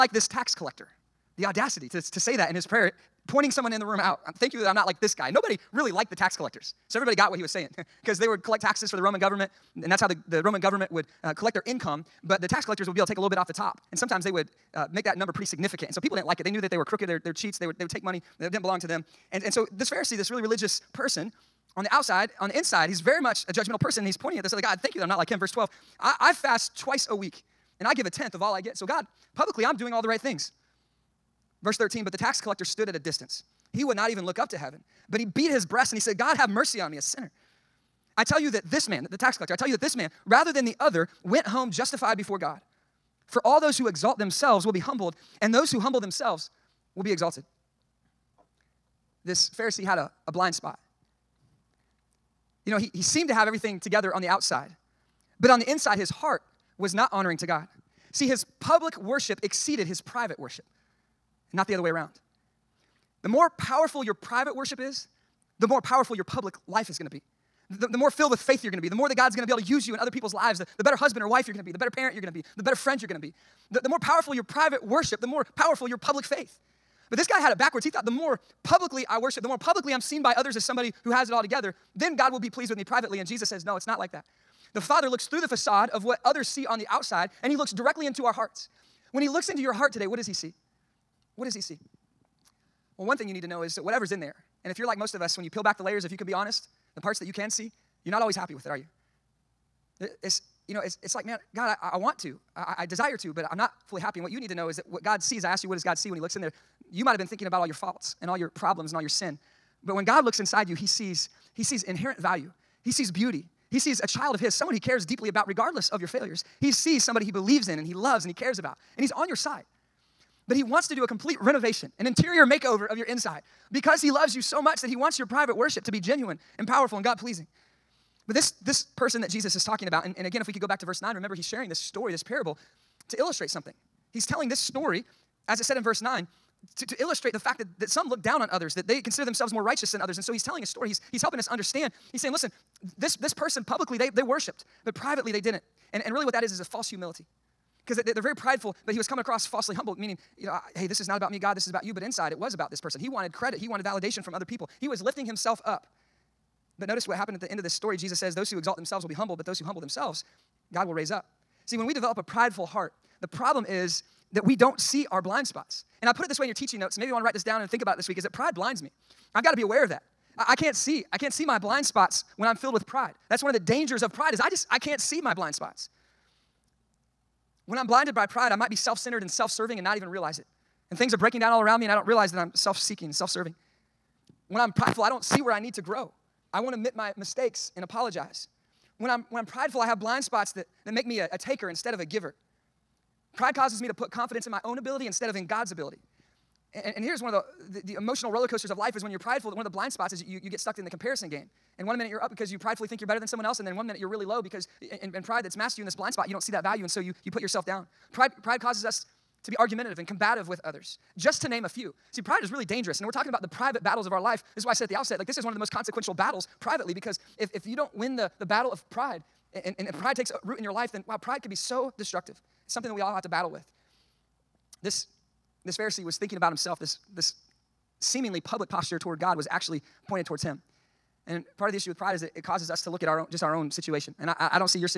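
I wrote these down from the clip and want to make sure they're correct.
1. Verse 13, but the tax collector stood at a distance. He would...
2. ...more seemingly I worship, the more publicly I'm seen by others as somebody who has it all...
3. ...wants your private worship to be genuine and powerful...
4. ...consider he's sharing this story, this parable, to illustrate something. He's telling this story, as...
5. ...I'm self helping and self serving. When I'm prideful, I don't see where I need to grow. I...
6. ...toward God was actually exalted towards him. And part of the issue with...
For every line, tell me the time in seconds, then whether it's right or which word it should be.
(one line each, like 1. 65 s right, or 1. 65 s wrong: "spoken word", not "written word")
1. 31 s right
2. 78 s wrong: "publicly", not "seemingly"
3. 124 s right
4. 131 s wrong: "remember", not "consider"
5. 182 s wrong: "seeking", not "helping"
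6. 228 s wrong: "pointed", not "exalted".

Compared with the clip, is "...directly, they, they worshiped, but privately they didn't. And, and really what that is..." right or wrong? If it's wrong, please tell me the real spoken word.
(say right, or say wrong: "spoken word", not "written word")
wrong: "publicly", not "directly".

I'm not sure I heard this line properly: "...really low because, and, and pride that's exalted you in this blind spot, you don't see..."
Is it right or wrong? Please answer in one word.
wrong.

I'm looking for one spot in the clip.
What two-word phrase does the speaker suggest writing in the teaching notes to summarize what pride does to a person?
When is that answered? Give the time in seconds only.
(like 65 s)
168 s.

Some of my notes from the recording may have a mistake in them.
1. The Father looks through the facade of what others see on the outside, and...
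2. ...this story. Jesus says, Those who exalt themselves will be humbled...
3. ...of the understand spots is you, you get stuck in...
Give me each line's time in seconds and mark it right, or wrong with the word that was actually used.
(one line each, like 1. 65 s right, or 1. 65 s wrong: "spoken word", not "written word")
1. 84 s right
2. 157 s right
3. 199 s wrong: "blind", not "understand".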